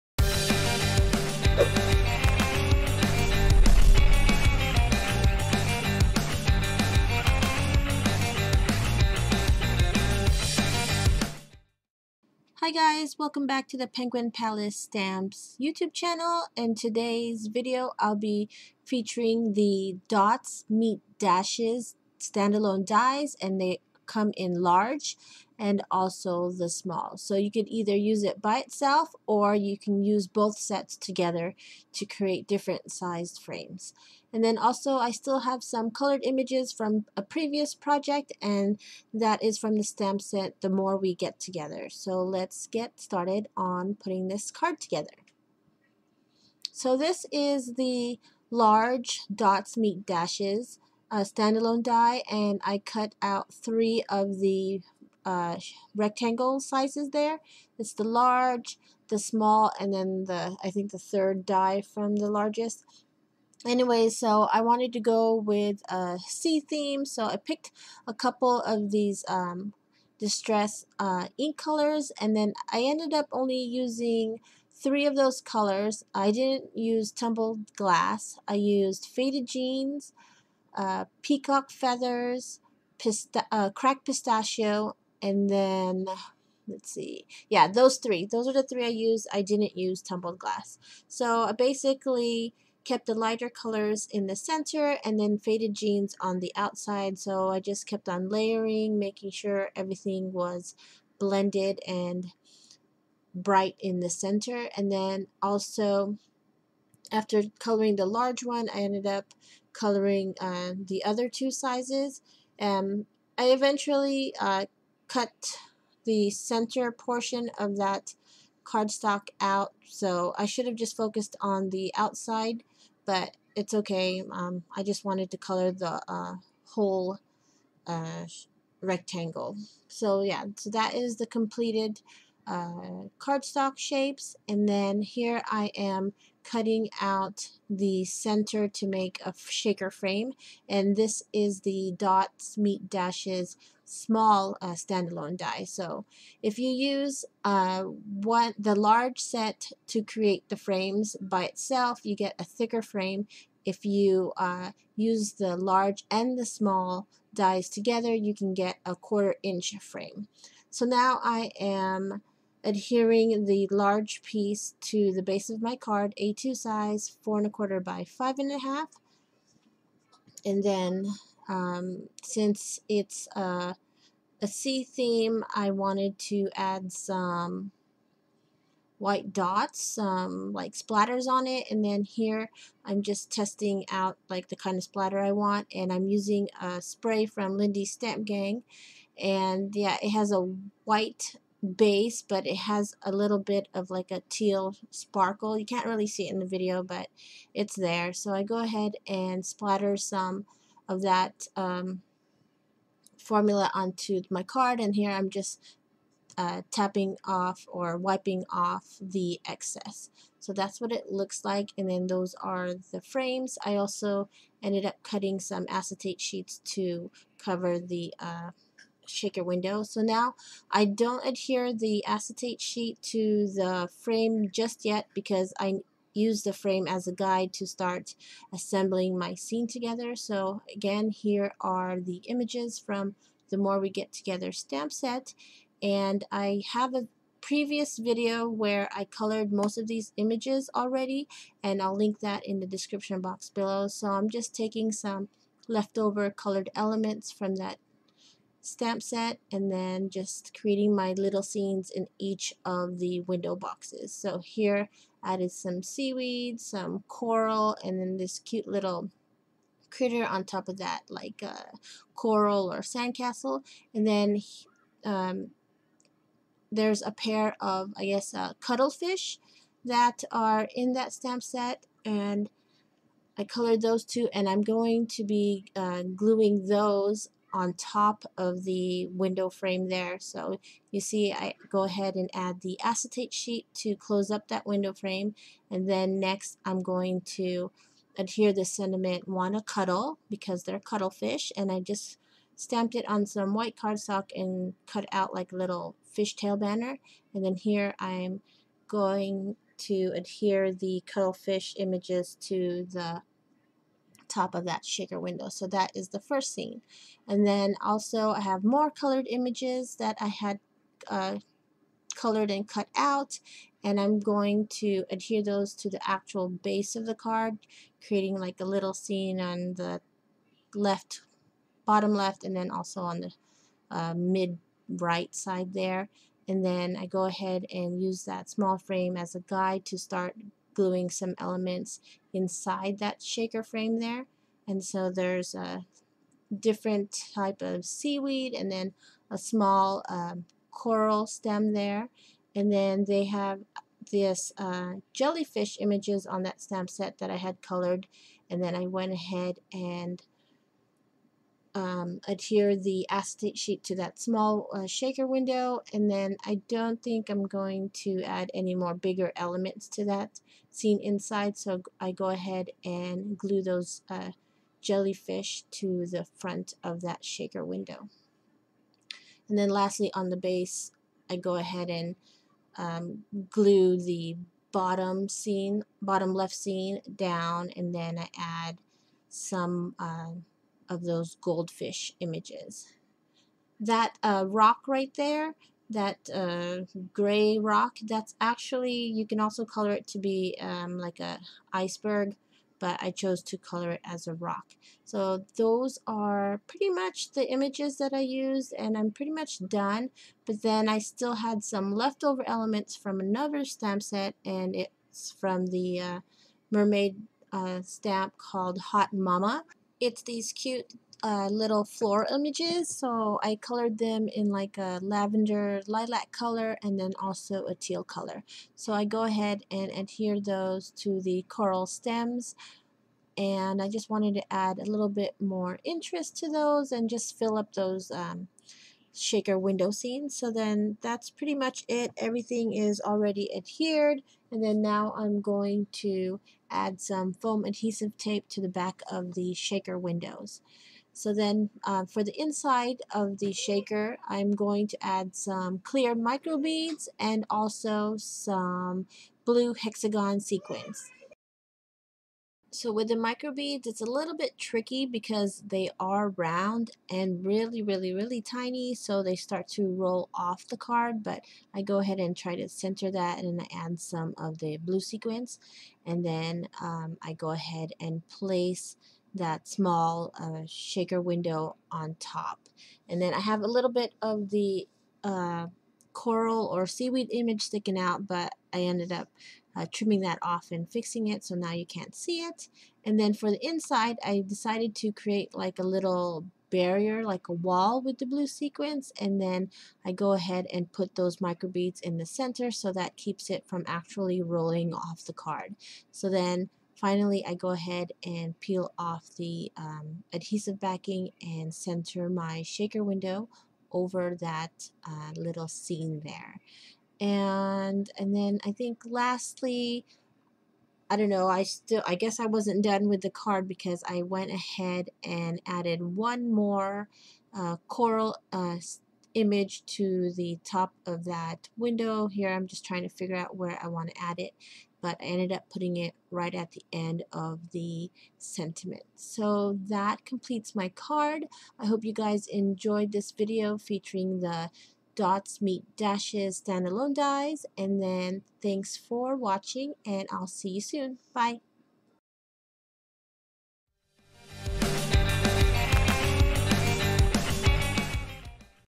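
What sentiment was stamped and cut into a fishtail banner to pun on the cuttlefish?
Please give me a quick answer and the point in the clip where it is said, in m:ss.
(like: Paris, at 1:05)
wanna cuddle, at 4:49.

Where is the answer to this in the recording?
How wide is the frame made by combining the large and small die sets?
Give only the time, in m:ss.
2:38.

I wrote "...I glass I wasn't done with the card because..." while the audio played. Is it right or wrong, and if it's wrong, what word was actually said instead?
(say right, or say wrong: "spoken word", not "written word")
wrong: "guess", not "glass".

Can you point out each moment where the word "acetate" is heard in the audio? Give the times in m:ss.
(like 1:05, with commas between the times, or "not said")
3:35, 3:42, 4:42, 5:53.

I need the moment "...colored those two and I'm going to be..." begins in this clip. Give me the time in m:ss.
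4:33.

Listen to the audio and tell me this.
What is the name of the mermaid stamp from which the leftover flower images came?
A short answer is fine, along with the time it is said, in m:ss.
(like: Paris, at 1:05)
Hot Mama, at 6:48.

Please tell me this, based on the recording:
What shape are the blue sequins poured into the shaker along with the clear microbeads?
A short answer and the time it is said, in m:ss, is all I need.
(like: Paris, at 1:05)
hexagon, at 7:29.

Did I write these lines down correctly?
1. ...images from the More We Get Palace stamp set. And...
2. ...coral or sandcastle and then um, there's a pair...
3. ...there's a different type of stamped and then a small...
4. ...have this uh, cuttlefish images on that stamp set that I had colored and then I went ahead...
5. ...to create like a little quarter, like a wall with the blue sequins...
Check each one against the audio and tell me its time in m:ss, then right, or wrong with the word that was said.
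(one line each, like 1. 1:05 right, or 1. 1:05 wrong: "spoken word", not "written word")
1. 3:52 wrong: "Together", not "Palace"
2. 4:22 right
3. 5:35 wrong: "seaweed", not "stamped"
4. 5:43 wrong: "jellyfish", not "cuttlefish"
5. 8:04 wrong: "barrier", not "quarter".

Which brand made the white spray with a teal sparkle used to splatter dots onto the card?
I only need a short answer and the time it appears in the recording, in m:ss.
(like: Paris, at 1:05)
Lindy's Stamp Gang, at 3:07.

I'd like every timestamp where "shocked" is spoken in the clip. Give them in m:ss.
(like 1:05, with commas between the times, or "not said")
not said.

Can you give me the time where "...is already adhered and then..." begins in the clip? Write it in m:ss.
7:12.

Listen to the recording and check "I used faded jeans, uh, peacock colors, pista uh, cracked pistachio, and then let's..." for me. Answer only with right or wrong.
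wrong.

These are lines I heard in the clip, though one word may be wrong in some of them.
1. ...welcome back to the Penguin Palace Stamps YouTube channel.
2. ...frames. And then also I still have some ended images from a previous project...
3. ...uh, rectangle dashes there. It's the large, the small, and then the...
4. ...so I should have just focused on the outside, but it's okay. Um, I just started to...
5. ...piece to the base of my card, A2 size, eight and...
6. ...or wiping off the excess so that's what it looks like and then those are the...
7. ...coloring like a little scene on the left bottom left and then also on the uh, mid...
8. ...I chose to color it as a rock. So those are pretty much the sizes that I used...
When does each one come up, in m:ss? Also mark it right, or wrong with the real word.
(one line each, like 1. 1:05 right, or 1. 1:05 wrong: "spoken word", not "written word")
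1. 0:13 right
2. 0:33 wrong: "colored", not "ended"
3. 0:55 wrong: "sizes", not "dashes"
4. 1:59 wrong: "wanted", not "started"
5. 2:44 wrong: "four", not "eight"
6. 3:27 right
7. 5:18 wrong: "creating", not "coloring"
8. 6:33 wrong: "images", not "sizes".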